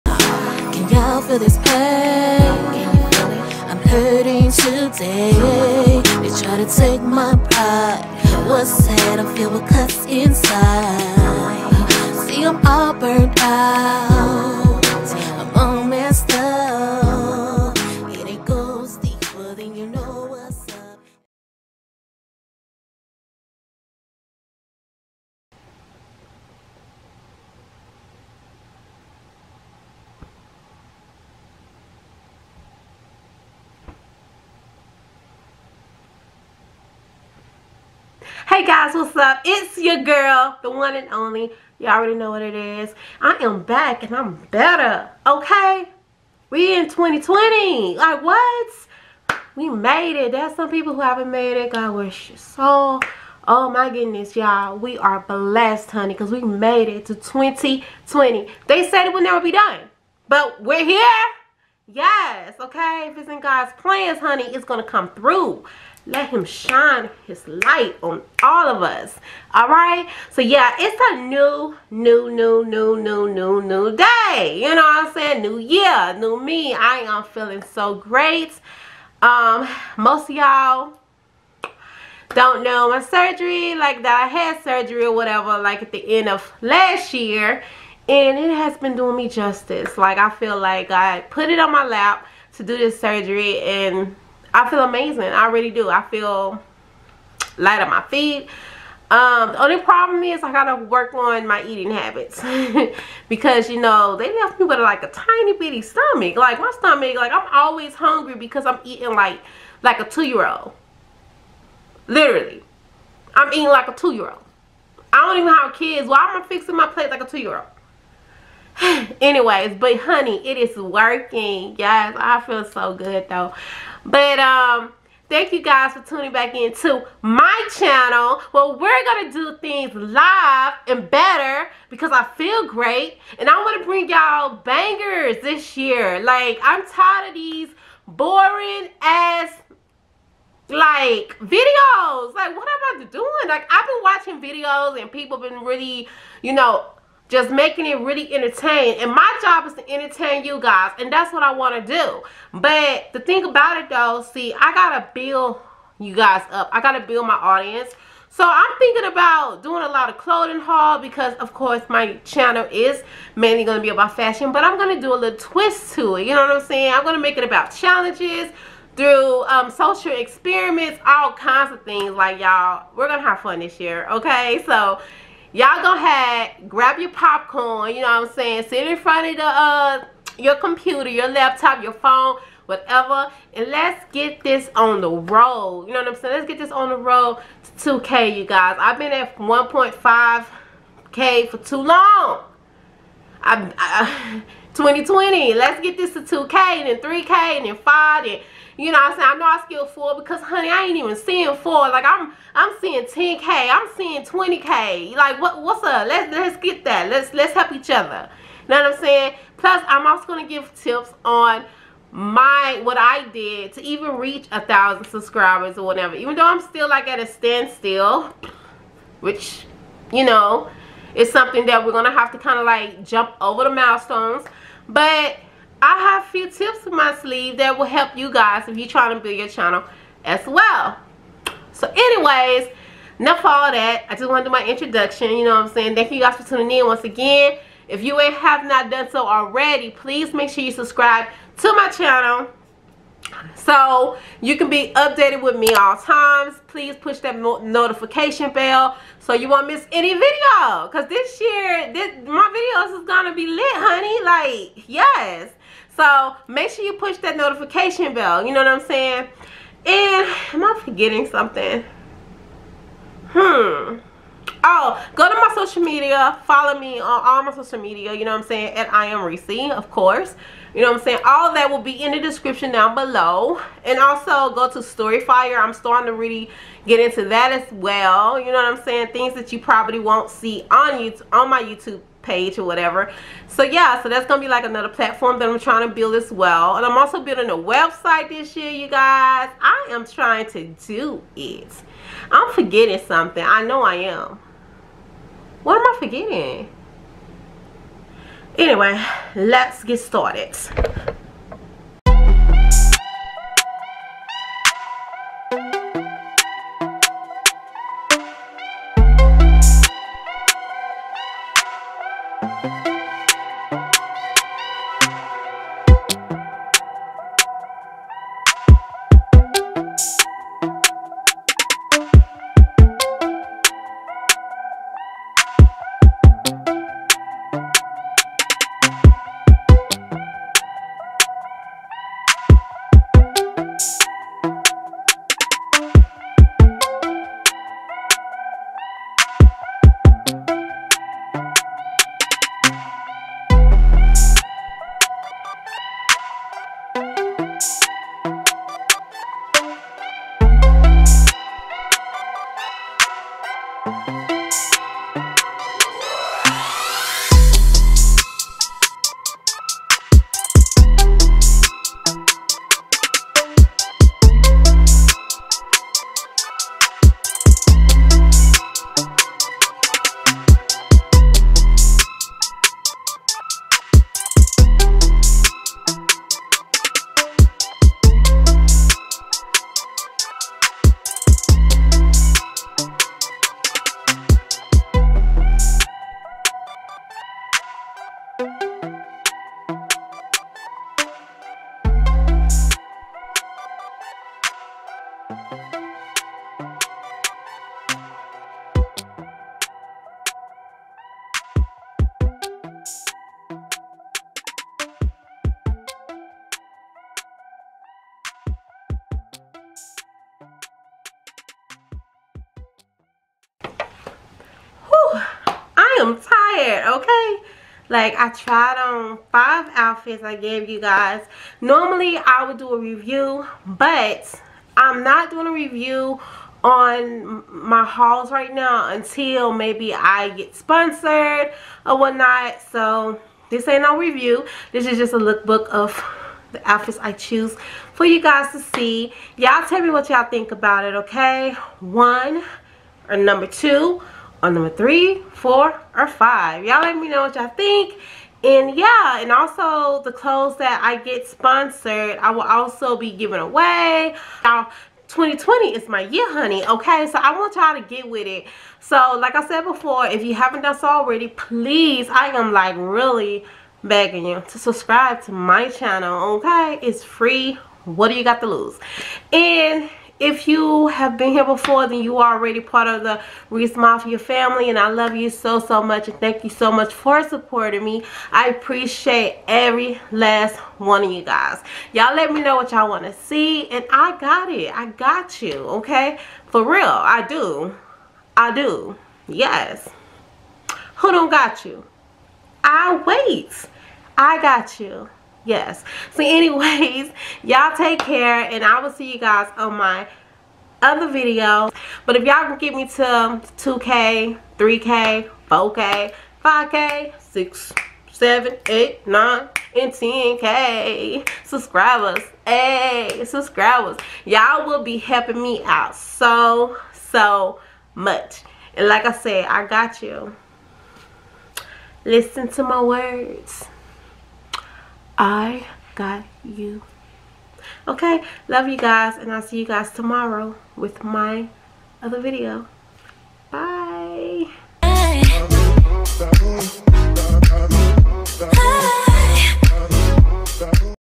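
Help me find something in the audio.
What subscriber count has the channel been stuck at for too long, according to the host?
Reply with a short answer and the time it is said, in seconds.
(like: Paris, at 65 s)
1.5k, at 189 s.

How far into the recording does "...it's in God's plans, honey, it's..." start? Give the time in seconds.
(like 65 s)
63 s.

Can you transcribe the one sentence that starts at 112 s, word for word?
Literally, I'm eating like a two year old.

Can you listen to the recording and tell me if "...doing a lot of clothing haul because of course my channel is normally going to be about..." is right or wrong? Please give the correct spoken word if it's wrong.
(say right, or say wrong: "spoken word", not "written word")
wrong: "mainly", not "normally".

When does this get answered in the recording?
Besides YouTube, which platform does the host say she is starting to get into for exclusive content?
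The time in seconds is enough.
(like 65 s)
274 s.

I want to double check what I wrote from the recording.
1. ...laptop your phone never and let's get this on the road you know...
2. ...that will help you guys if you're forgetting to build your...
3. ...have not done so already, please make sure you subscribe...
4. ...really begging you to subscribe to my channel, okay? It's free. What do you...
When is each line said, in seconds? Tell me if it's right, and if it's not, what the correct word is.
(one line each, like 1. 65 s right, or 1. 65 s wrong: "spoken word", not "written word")
1. 181 s wrong: "whatever", not "never"
2. 227 s wrong: "trying", not "forgetting"
3. 238 s right
4. 462 s right.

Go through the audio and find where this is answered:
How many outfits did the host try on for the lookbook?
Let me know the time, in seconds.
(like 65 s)
419 s.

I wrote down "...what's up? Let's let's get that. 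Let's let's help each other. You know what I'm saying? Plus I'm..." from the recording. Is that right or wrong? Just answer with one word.
right.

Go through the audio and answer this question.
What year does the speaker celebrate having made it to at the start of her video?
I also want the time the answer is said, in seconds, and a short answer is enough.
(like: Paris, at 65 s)
2020, at 46 s.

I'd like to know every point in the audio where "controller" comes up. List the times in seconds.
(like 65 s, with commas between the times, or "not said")
not said.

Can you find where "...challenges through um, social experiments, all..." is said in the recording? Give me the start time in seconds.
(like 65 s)
167 s.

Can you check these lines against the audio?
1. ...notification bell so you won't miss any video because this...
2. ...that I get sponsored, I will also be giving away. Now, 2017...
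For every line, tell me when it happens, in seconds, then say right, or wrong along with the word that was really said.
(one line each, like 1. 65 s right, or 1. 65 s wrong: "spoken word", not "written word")
1. 247 s right
2. 450 s wrong: "2020", not "2017".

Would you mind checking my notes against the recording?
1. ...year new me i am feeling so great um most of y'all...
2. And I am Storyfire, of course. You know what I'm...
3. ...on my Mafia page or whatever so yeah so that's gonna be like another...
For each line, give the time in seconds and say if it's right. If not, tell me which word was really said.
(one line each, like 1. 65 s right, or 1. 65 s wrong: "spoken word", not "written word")
1. 75 s right
2. 268 s wrong: "Reesi", not "Storyfire"
3. 281 s wrong: "YouTube", not "Mafia".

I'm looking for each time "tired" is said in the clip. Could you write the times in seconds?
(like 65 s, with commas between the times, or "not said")
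136 s.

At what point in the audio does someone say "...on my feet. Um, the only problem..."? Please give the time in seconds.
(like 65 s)
97 s.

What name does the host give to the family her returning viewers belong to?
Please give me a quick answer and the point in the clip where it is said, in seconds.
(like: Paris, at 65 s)
Reesi Mafia, at 473 s.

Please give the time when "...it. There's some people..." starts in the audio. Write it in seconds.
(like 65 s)
50 s.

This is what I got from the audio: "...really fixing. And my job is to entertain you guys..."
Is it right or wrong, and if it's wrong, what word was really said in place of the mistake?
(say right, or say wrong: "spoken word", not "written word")
wrong: "entertaining", not "fixing".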